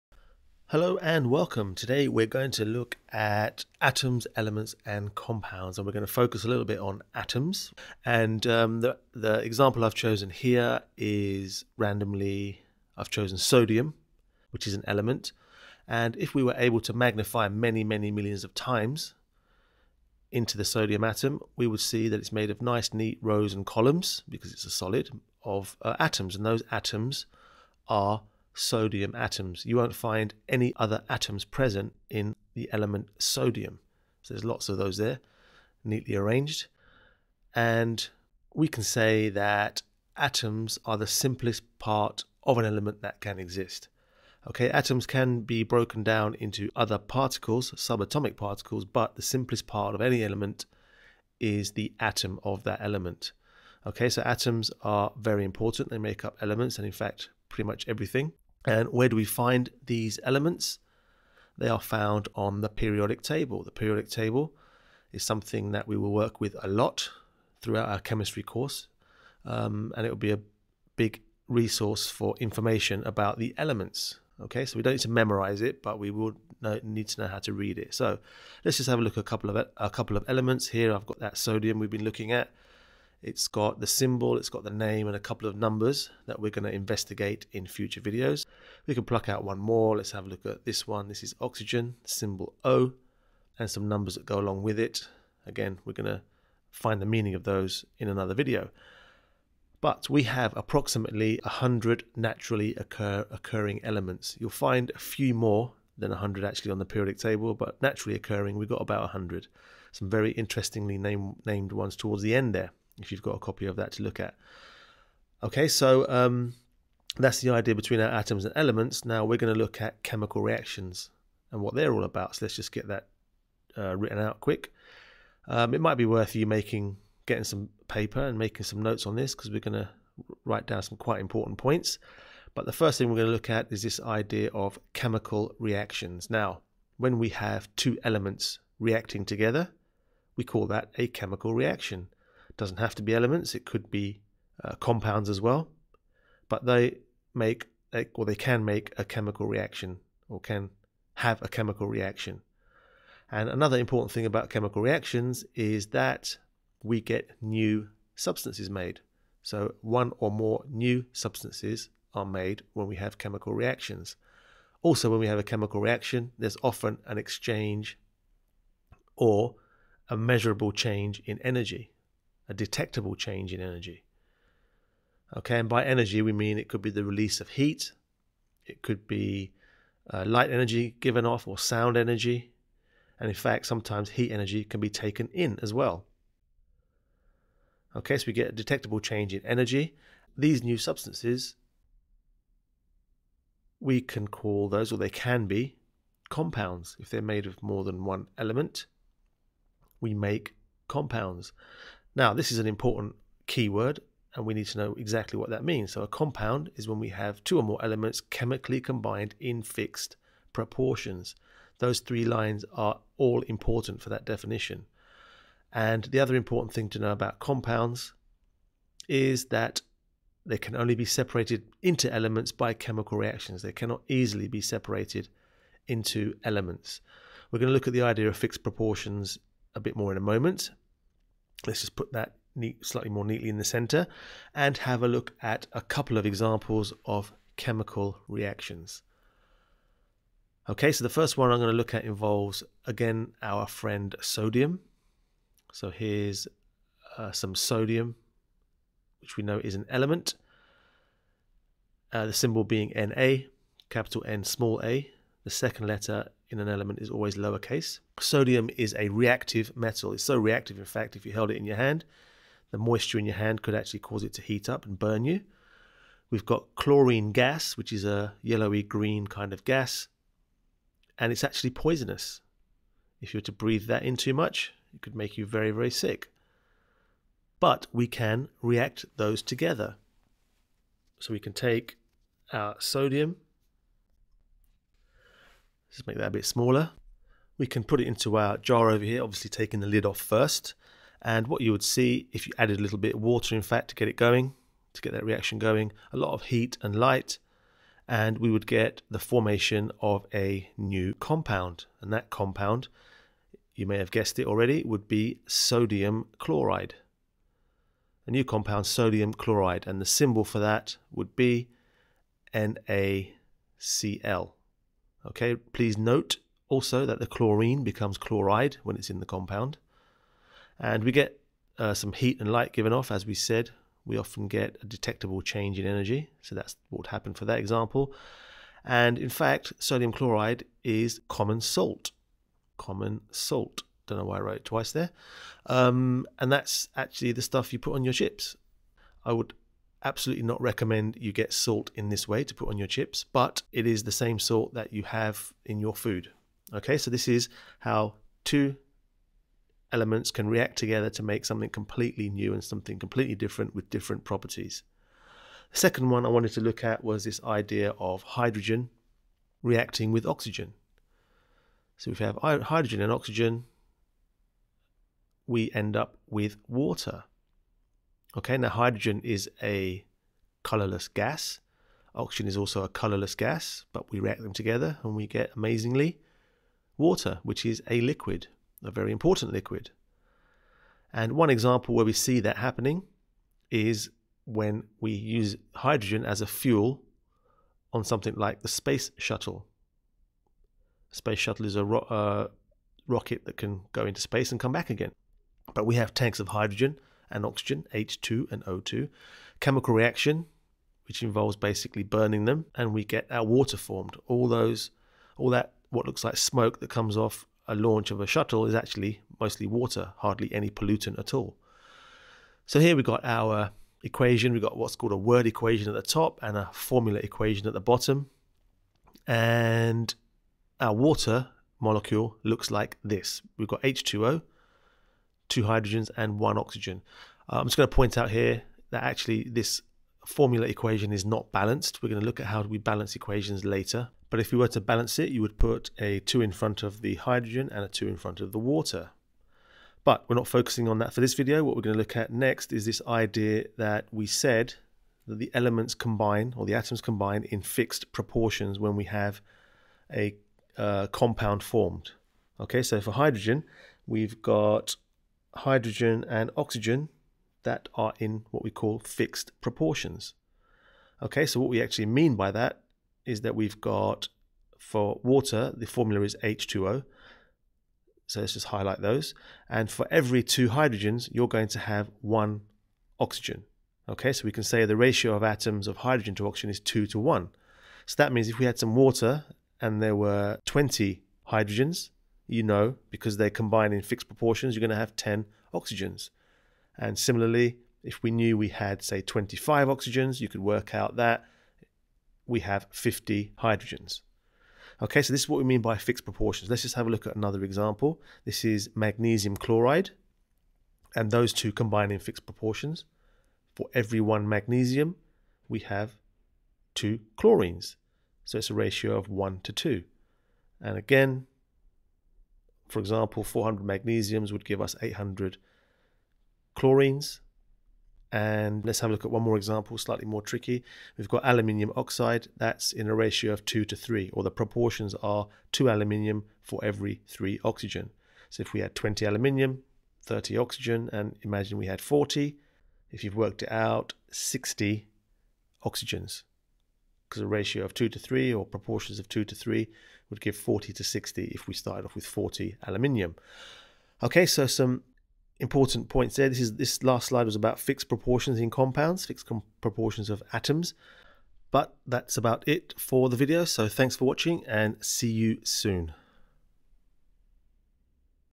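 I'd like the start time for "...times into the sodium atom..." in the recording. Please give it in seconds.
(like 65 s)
18 s.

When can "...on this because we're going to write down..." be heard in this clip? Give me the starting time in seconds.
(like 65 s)
129 s.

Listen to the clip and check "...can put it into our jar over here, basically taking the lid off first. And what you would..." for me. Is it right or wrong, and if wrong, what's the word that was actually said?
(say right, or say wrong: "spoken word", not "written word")
wrong: "obviously", not "basically".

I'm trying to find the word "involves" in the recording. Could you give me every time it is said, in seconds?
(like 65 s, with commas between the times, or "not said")
242 s, 401 s.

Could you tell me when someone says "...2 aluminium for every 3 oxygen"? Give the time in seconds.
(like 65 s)
525 s.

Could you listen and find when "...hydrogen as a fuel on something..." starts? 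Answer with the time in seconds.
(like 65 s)
385 s.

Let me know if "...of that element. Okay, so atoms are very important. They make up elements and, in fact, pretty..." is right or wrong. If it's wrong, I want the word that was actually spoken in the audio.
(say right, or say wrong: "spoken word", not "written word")
right.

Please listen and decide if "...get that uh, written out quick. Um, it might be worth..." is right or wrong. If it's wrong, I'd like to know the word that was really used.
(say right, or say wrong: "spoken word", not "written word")
right.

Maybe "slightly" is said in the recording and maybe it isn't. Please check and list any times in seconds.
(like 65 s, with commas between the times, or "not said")
232 s, 519 s.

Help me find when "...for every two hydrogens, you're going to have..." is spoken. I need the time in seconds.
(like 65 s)
469 s.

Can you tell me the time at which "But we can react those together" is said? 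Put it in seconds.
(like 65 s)
277 s.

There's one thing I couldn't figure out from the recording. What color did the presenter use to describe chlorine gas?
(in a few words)
Yellowy green.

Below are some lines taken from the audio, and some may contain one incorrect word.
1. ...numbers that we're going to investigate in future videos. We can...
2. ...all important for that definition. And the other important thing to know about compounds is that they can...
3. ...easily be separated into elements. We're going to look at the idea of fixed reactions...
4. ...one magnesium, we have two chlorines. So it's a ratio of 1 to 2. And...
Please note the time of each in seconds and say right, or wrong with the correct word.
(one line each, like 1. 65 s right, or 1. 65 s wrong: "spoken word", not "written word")
1. 85 s right
2. 213 s right
3. 224 s wrong: "proportions", not "reactions"
4. 504 s right.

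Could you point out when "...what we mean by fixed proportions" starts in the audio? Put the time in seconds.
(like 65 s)
495 s.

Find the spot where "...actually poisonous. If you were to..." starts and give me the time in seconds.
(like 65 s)
271 s.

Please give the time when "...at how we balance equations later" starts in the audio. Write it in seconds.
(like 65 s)
432 s.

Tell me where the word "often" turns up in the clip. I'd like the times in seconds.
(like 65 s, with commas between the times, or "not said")
166 s, 324 s.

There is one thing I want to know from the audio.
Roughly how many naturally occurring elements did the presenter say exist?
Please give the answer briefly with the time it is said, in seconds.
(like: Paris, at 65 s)
About 100, at 100 s.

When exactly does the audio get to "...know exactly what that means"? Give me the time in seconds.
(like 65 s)
204 s.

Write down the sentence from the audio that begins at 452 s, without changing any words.
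Okay, so for hydrogen, we've got hydrogen and oxygen that are in what we call fixed proportions.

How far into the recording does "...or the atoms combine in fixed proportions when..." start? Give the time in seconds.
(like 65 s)
446 s.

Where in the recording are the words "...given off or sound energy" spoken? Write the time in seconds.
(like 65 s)
180 s.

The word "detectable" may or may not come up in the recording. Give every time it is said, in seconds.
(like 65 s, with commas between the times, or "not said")
172 s, 188 s, 324 s.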